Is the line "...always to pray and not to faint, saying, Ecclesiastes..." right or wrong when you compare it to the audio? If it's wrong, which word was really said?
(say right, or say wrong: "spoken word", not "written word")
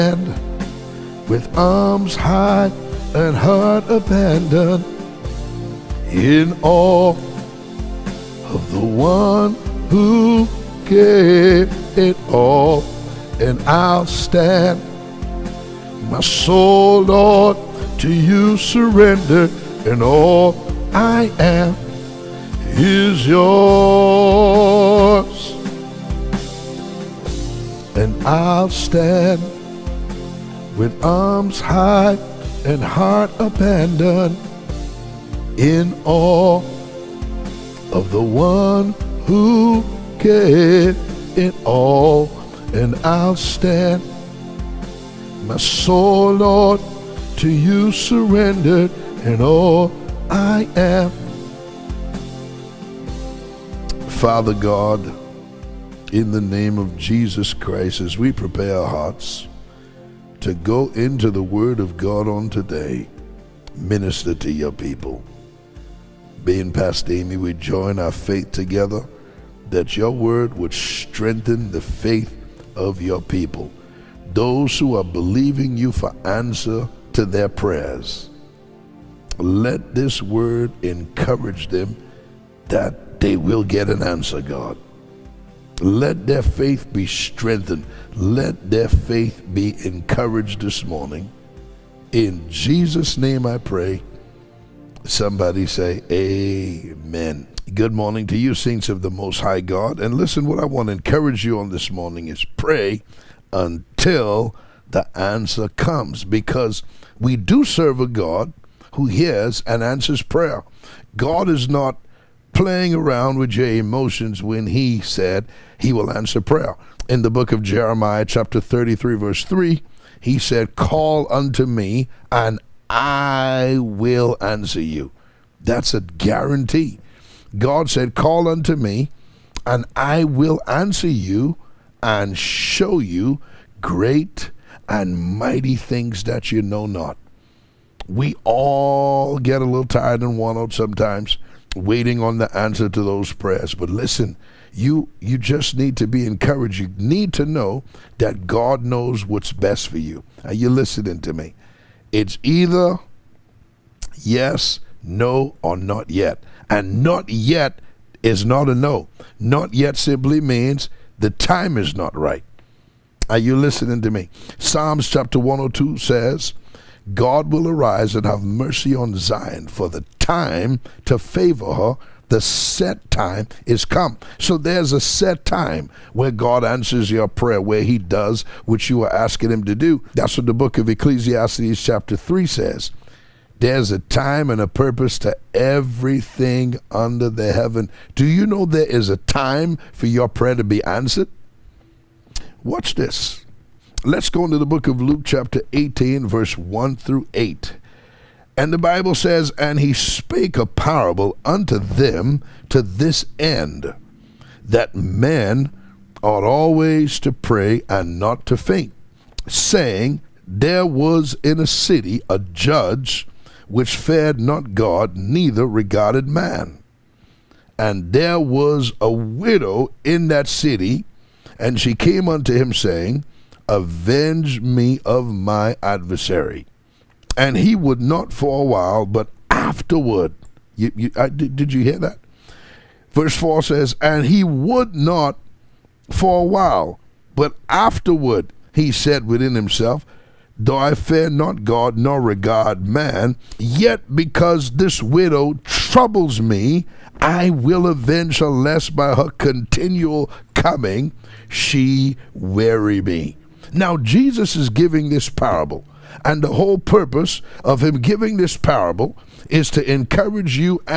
wrong: "There", not "Ecclesiastes".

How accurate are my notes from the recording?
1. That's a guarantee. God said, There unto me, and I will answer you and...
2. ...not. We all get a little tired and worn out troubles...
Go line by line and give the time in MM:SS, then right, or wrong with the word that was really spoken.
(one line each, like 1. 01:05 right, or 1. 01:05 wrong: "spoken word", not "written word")
1. 02:05 wrong: "Call", not "There"
2. 02:16 wrong: "sometimes", not "troubles".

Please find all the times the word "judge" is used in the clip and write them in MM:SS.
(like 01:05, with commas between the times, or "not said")
03:32.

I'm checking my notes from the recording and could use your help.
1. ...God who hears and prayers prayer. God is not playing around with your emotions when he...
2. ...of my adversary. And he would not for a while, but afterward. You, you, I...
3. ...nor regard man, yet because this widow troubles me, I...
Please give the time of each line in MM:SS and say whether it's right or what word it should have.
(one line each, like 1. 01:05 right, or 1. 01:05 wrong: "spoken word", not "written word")
1. 01:48 wrong: "answers", not "prayers"
2. 03:45 right
3. 04:01 right.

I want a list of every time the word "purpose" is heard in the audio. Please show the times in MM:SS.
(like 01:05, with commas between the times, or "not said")
03:04, 04:16.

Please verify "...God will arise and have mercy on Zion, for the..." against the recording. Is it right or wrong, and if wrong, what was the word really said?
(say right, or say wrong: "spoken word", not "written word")
right.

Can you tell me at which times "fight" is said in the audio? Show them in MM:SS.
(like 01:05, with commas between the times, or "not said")
not said.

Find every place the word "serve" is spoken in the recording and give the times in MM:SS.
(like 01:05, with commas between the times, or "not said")
01:47.